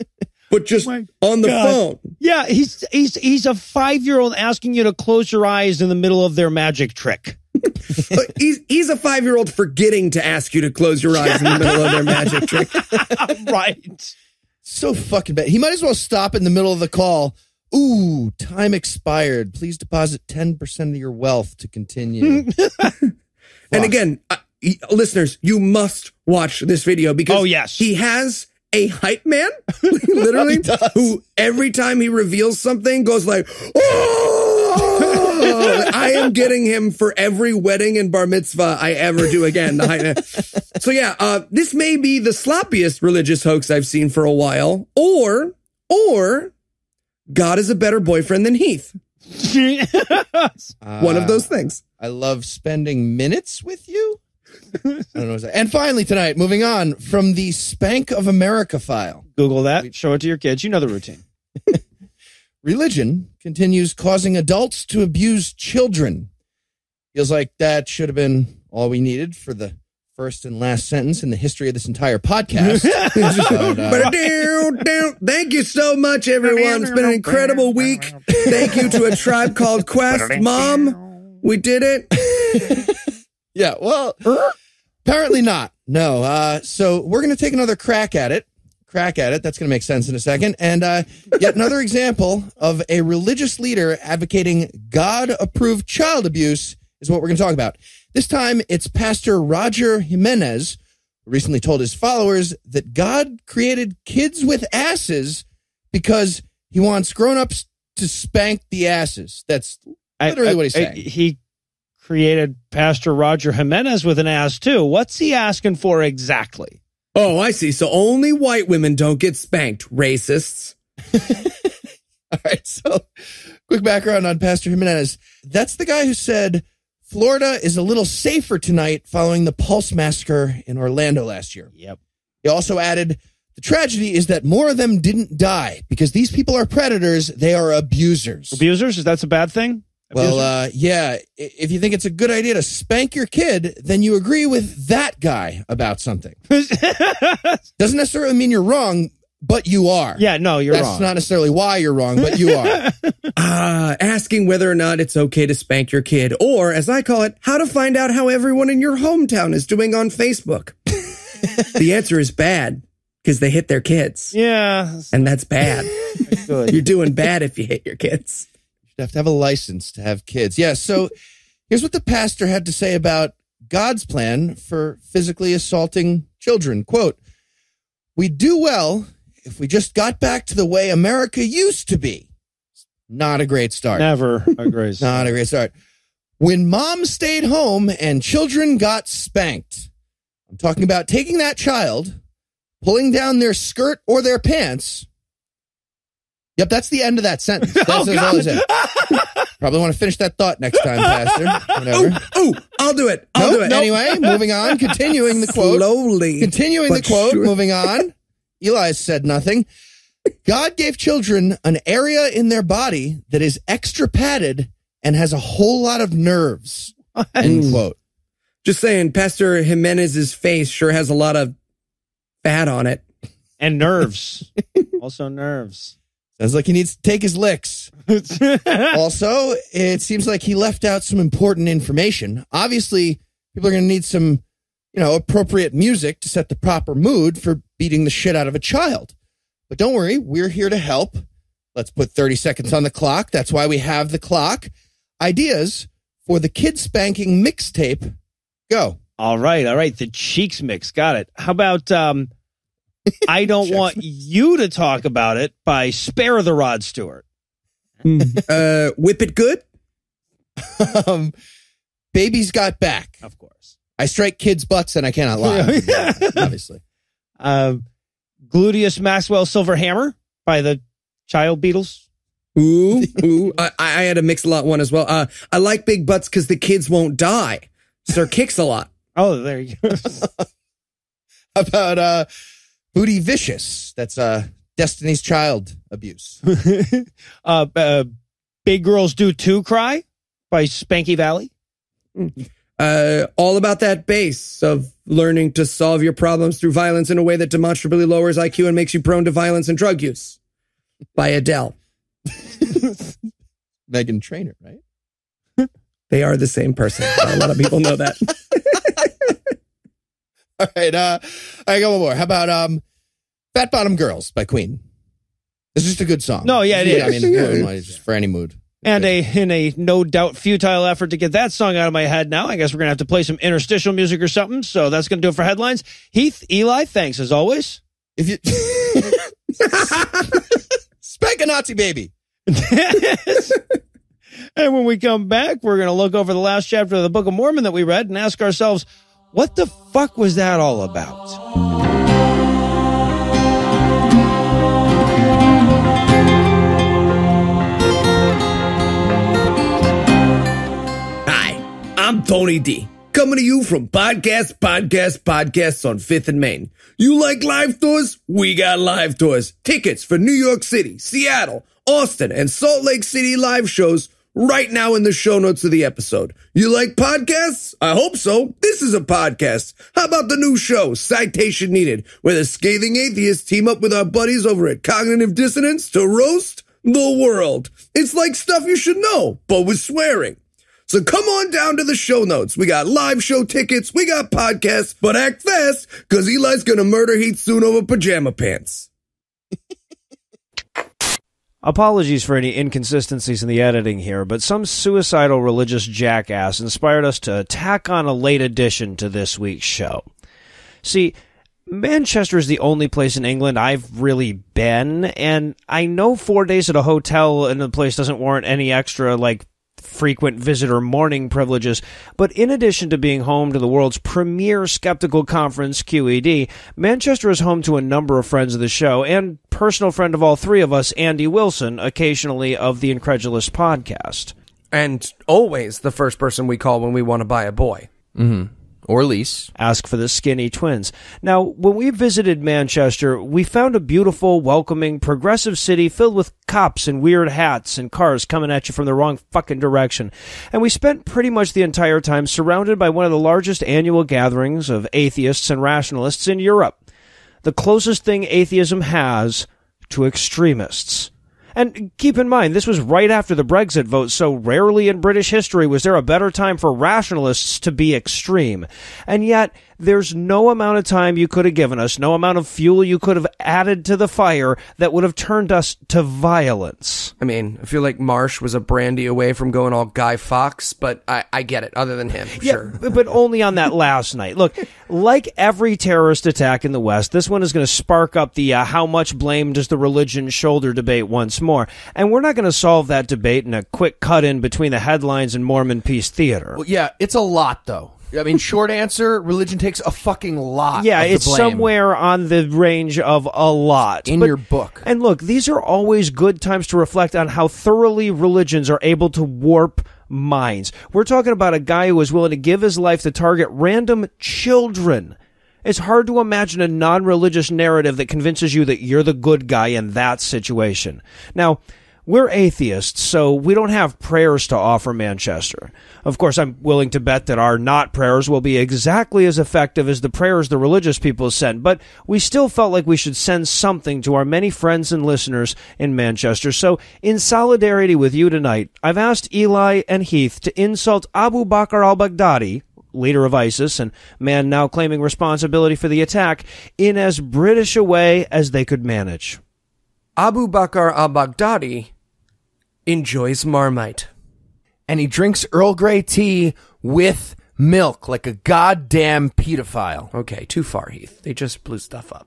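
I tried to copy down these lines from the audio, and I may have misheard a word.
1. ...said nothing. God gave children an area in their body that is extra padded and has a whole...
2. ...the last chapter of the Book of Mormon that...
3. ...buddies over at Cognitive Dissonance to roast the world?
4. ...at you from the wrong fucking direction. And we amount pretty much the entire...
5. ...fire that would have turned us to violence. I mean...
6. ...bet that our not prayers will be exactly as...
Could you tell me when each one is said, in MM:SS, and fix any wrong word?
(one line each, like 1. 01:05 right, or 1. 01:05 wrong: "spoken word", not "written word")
1. 03:28 right
2. 05:36 right
3. 06:14 right
4. 07:18 wrong: "spent", not "amount"
5. 07:44 right
6. 08:37 right.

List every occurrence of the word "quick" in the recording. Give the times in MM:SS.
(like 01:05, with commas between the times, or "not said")
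02:03, 08:03.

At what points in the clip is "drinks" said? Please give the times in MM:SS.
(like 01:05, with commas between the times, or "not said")
09:05.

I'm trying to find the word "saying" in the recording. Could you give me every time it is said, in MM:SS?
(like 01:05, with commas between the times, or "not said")
01:50, 03:38.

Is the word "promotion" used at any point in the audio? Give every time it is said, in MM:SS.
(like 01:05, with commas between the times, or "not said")
not said.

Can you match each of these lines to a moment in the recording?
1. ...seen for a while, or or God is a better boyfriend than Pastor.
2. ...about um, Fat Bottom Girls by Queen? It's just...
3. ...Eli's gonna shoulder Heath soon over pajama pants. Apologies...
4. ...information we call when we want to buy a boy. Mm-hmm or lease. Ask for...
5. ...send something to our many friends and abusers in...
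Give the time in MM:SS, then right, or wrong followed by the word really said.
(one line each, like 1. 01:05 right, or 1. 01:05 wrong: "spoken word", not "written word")
1. 00:43 wrong: "Heath", not "Pastor"
2. 05:12 right
3. 06:26 wrong: "murder", not "shoulder"
4. 07:06 wrong: "person", not "information"
5. 08:43 wrong: "listeners", not "abusers".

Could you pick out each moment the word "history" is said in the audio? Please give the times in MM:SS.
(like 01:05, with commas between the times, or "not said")
01:11, 07:35.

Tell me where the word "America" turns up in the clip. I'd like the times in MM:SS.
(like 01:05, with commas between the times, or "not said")
00:58, 03:00.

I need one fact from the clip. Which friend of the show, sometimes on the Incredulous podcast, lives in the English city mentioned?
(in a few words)
Andy Wilson.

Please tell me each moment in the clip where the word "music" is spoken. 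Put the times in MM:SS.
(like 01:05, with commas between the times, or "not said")
03:55, 05:23.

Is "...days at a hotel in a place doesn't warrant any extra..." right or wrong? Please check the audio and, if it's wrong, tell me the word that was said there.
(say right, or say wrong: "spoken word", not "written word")
right.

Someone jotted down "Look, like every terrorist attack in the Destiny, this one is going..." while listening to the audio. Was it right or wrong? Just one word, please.
wrong.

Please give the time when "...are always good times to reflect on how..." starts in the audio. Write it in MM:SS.
08:15.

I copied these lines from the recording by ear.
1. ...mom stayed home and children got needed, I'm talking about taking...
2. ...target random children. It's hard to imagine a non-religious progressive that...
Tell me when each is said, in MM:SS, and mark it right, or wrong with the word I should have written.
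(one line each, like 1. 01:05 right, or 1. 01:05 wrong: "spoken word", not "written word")
1. 03:06 wrong: "spanked", not "needed"
2. 08:23 wrong: "narrative", not "progressive".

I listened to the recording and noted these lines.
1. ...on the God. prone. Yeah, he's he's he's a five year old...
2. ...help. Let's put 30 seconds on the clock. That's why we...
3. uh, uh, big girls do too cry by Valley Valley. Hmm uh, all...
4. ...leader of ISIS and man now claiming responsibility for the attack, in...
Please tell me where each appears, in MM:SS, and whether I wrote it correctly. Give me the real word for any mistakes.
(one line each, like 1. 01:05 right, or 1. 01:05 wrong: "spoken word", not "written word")
1. 00:01 wrong: "phone", not "prone"
2. 04:00 right
3. 04:47 wrong: "Spanky", not "Valley"
4. 08:52 right.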